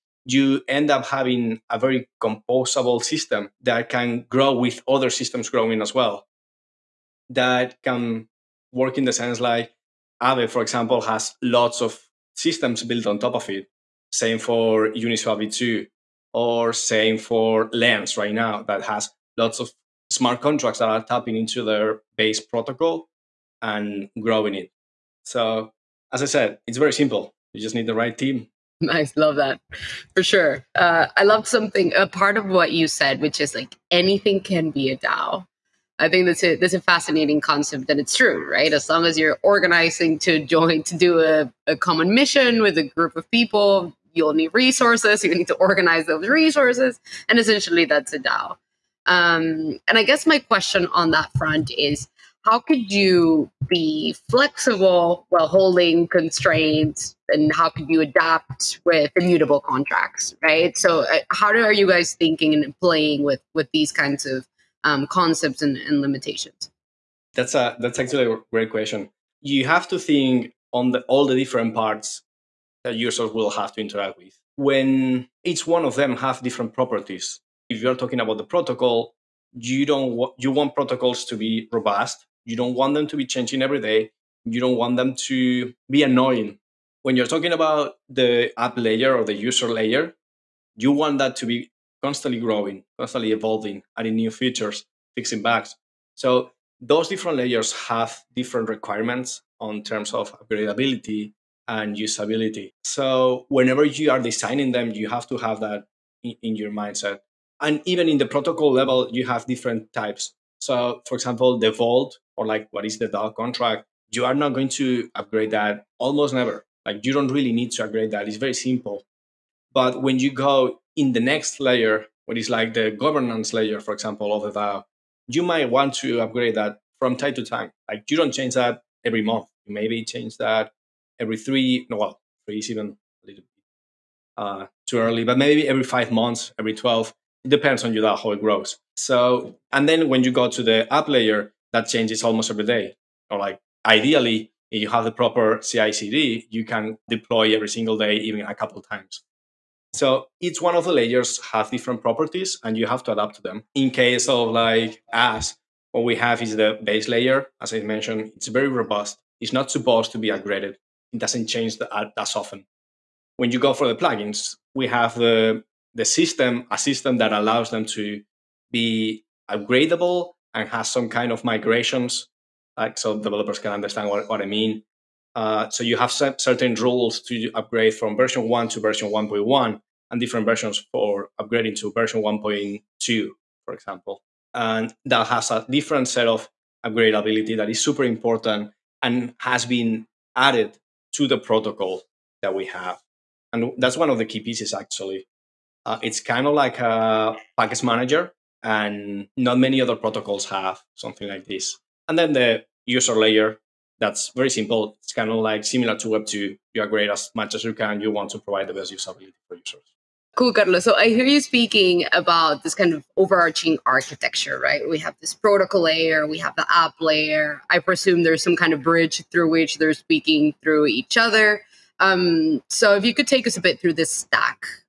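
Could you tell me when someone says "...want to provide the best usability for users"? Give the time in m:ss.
3:28.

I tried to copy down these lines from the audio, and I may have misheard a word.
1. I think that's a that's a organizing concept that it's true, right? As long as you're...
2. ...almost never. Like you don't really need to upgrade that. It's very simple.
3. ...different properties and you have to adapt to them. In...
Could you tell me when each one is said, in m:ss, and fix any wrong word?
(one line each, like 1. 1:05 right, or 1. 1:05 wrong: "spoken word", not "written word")
1. 0:36 wrong: "fascinating", not "organizing"
2. 1:55 right
3. 2:31 right.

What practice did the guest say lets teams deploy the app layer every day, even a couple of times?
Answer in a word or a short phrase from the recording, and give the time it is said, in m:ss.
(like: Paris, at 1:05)
CI/CD, at 2:25.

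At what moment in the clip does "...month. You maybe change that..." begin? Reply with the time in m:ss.
2:09.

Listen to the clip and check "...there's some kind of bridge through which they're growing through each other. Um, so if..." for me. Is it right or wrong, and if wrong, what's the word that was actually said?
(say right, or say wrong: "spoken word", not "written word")
wrong: "speaking", not "growing".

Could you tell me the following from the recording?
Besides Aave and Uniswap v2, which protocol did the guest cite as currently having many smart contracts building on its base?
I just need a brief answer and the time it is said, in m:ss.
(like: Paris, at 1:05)
Lens, at 0:17.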